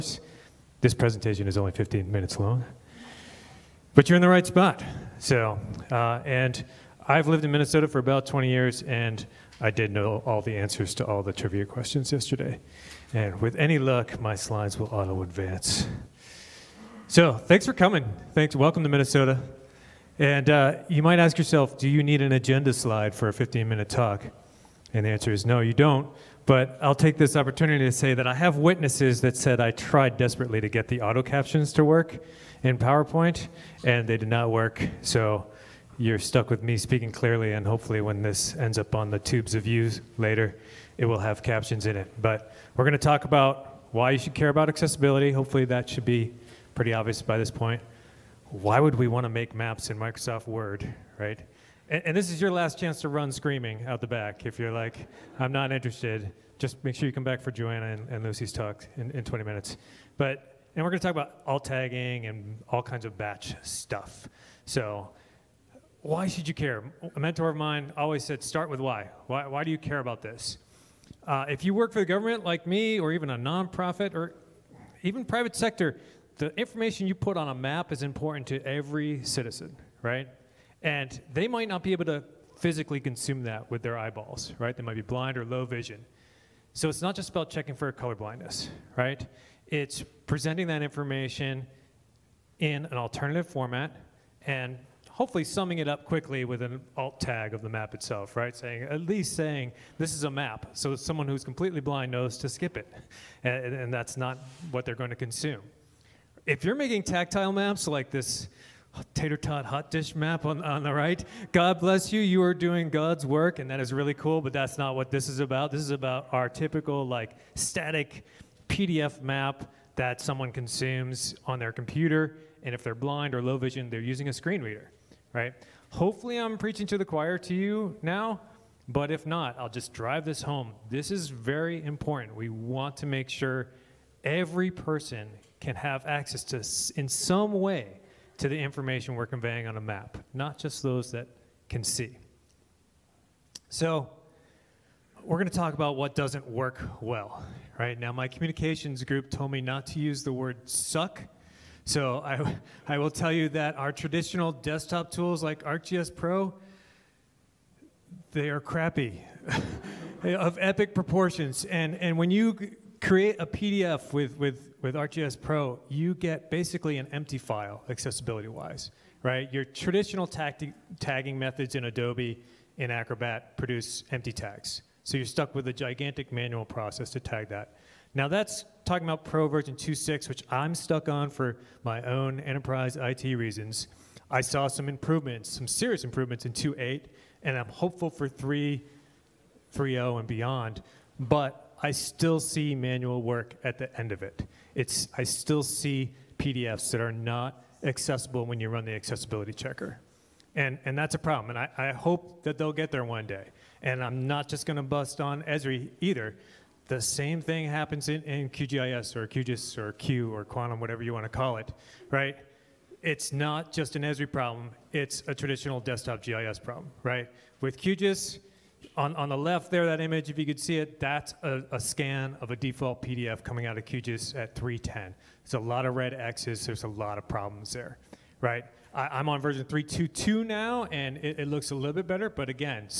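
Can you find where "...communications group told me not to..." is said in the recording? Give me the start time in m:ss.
2:28.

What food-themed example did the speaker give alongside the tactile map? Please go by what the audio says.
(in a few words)
tater tot hot dish.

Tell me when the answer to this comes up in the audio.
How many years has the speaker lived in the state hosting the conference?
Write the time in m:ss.
0:07.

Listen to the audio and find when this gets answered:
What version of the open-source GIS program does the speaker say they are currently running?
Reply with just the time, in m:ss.
3:49.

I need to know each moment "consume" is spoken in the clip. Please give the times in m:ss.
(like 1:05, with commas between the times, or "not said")
1:22, 1:45, 2:00.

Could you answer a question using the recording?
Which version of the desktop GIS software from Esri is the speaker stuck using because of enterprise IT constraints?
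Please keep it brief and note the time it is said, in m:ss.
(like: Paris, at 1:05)
2.6, at 2:59.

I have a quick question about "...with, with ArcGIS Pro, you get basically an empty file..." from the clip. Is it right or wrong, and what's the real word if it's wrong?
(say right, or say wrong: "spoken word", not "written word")
right.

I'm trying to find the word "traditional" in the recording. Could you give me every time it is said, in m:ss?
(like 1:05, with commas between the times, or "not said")
2:33, 2:49, 3:35.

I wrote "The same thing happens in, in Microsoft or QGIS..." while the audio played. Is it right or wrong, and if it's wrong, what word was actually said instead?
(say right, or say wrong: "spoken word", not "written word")
wrong: "QGIS", not "Microsoft".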